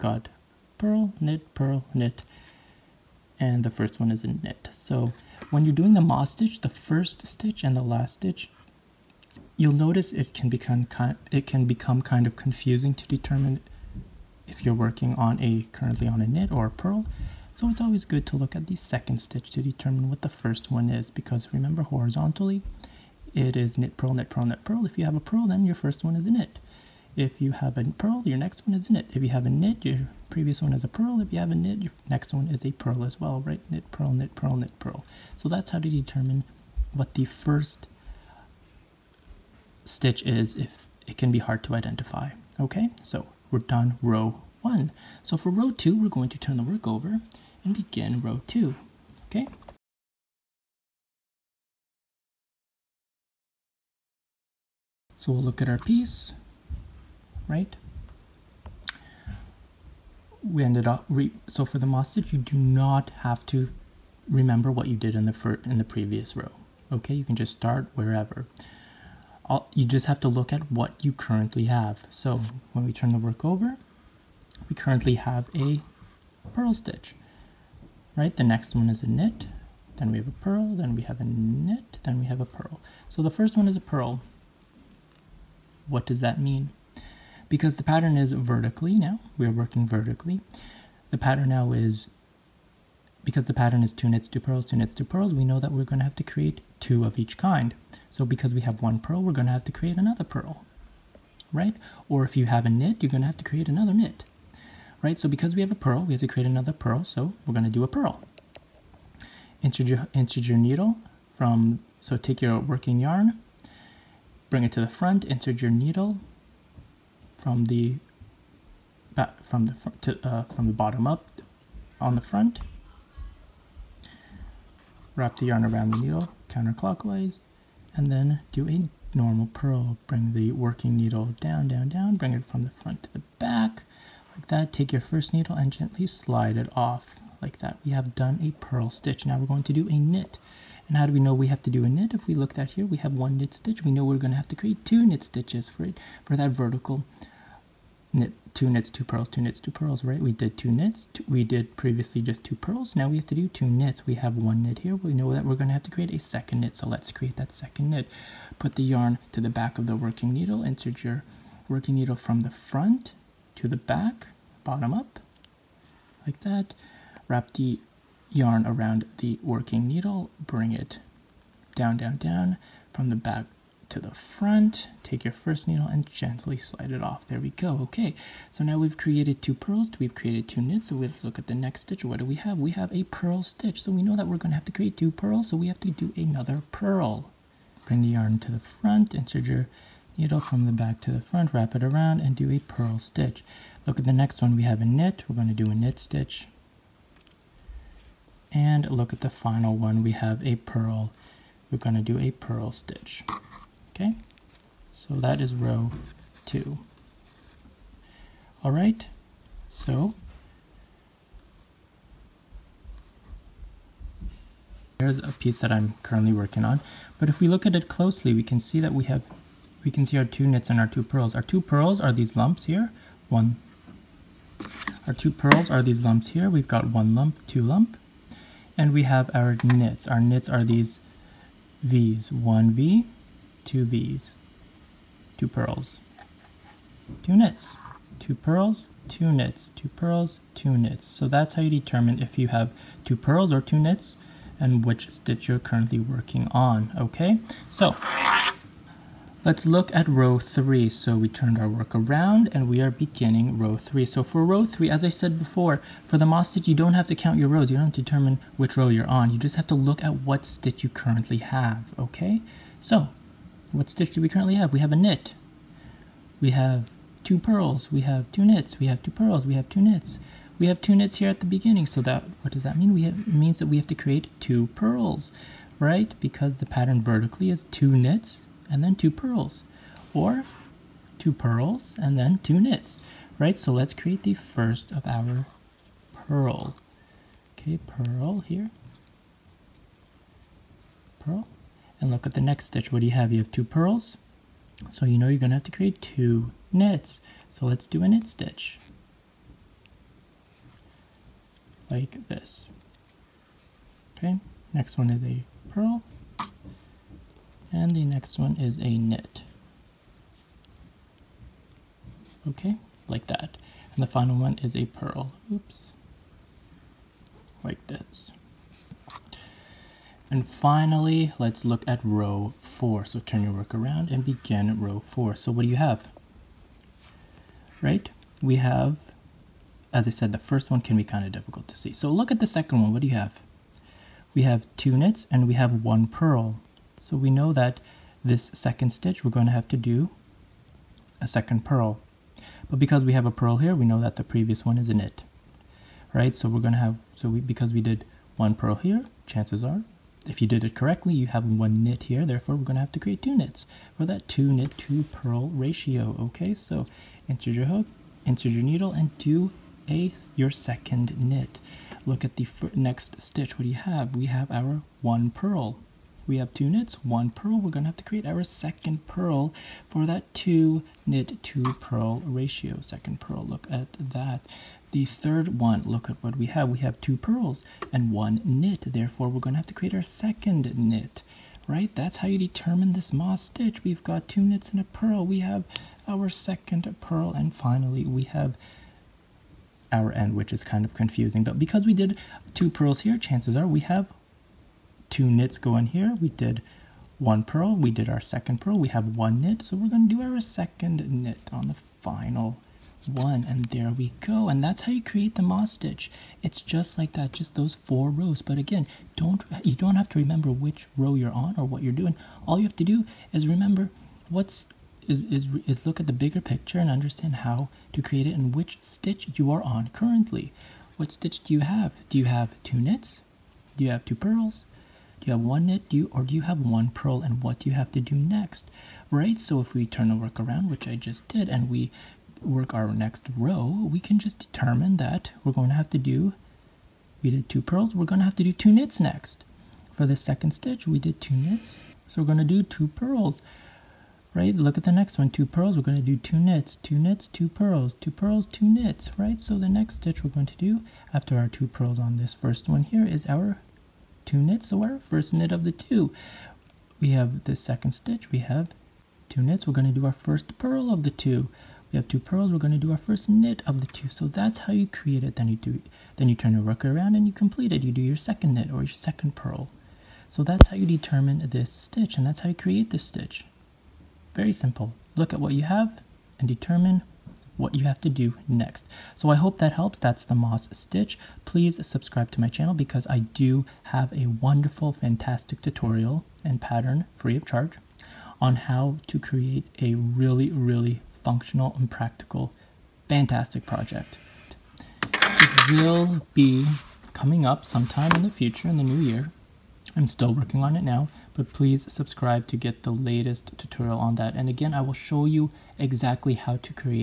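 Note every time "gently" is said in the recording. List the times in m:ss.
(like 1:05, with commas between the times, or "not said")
2:15, 2:56.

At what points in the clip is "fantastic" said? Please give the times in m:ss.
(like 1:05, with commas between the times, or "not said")
8:04, 8:13.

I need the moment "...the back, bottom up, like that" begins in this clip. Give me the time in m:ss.
2:43.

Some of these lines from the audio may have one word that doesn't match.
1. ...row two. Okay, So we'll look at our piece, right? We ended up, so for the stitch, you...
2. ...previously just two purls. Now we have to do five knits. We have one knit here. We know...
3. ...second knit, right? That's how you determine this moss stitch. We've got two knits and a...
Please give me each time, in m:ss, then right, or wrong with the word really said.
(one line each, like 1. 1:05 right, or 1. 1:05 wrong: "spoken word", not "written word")
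1. 0:48 right
2. 2:31 wrong: "two", not "five"
3. 6:20 right.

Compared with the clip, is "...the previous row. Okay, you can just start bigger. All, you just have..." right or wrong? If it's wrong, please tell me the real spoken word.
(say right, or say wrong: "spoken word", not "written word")
wrong: "wherever", not "bigger".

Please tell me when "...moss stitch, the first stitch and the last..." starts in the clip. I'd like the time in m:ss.
0:06.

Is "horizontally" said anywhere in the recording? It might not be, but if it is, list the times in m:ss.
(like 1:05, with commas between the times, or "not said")
0:21.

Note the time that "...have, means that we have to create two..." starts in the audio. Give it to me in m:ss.
4:33.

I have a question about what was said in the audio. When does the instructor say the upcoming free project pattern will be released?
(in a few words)
In the new year.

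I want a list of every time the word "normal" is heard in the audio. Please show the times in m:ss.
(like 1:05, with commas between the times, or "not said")
2:09.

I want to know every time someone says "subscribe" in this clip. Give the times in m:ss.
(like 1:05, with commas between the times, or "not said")
8:01, 8:21.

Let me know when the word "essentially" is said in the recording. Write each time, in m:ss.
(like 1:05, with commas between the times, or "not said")
not said.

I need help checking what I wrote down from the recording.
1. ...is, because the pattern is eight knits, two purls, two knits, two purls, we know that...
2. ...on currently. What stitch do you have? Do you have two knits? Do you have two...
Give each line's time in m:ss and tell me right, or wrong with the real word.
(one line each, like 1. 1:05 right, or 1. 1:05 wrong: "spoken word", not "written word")
1. 1:31 wrong: "two", not "eight"
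2. 6:59 right.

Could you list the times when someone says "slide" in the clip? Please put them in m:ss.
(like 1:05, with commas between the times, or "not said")
2:16, 2:56.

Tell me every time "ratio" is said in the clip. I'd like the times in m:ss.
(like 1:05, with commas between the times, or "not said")
5:55, 6:12.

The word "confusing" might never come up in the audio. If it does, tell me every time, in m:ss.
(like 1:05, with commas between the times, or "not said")
0:12, 6:30.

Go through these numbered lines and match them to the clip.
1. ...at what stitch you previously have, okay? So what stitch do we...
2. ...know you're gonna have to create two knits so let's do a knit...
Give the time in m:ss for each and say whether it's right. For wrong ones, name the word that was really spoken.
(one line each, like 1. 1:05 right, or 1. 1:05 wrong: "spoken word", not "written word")
1. 4:20 wrong: "currently", not "previously"
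2. 4:55 right.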